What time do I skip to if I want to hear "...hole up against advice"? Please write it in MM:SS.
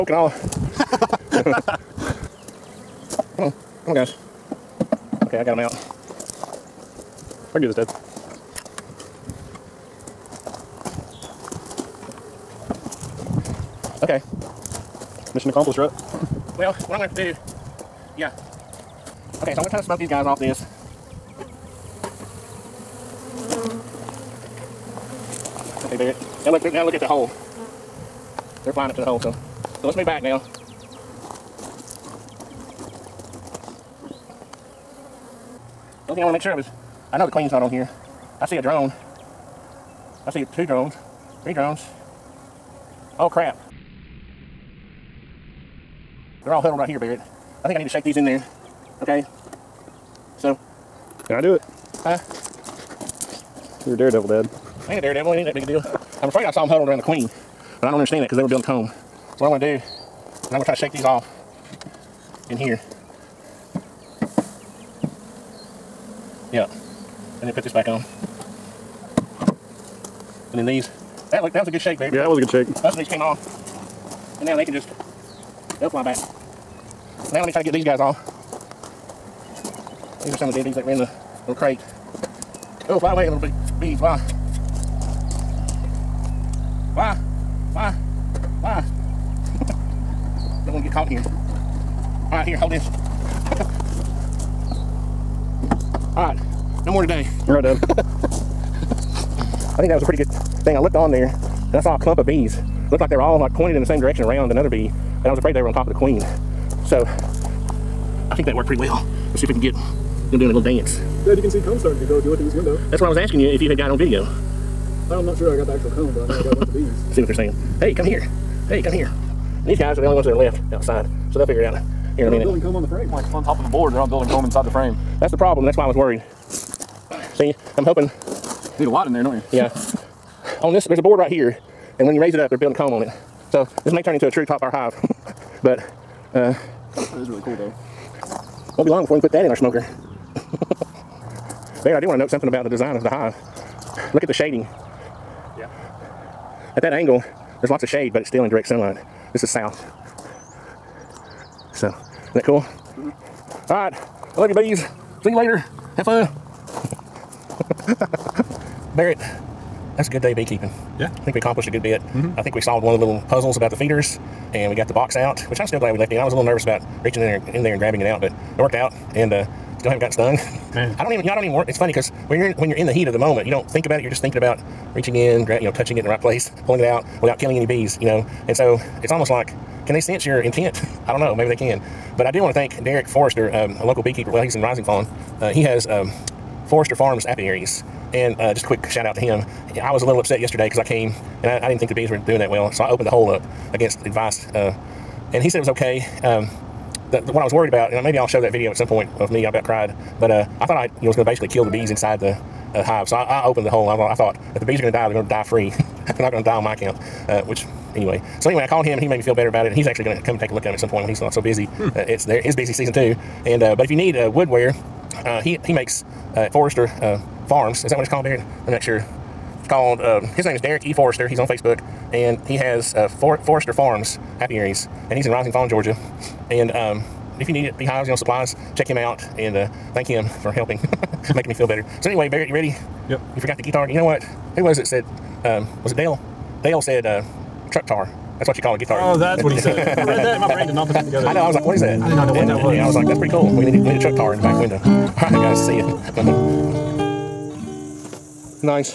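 03:13.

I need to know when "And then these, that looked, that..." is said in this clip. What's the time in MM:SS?
01:10.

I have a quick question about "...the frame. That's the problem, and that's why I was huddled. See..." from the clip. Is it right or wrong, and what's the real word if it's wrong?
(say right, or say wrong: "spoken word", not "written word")
wrong: "worried", not "huddled".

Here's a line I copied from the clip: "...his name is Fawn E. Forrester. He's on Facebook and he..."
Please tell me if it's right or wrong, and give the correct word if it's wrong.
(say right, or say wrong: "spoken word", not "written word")
wrong: "Derek", not "Fawn".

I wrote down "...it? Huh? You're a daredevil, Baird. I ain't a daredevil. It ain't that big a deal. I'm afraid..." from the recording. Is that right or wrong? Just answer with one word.
wrong.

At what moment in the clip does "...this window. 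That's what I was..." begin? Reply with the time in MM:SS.
01:52.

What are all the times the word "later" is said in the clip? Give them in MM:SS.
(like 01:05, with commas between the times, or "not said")
02:35.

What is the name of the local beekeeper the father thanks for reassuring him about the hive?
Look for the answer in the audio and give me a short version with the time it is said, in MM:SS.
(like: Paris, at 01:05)
Derek Forrester, at 03:02.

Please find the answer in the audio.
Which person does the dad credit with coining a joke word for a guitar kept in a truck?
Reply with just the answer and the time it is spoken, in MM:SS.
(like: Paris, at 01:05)
Dale, at 03:56.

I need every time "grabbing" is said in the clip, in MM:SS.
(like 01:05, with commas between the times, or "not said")
02:47.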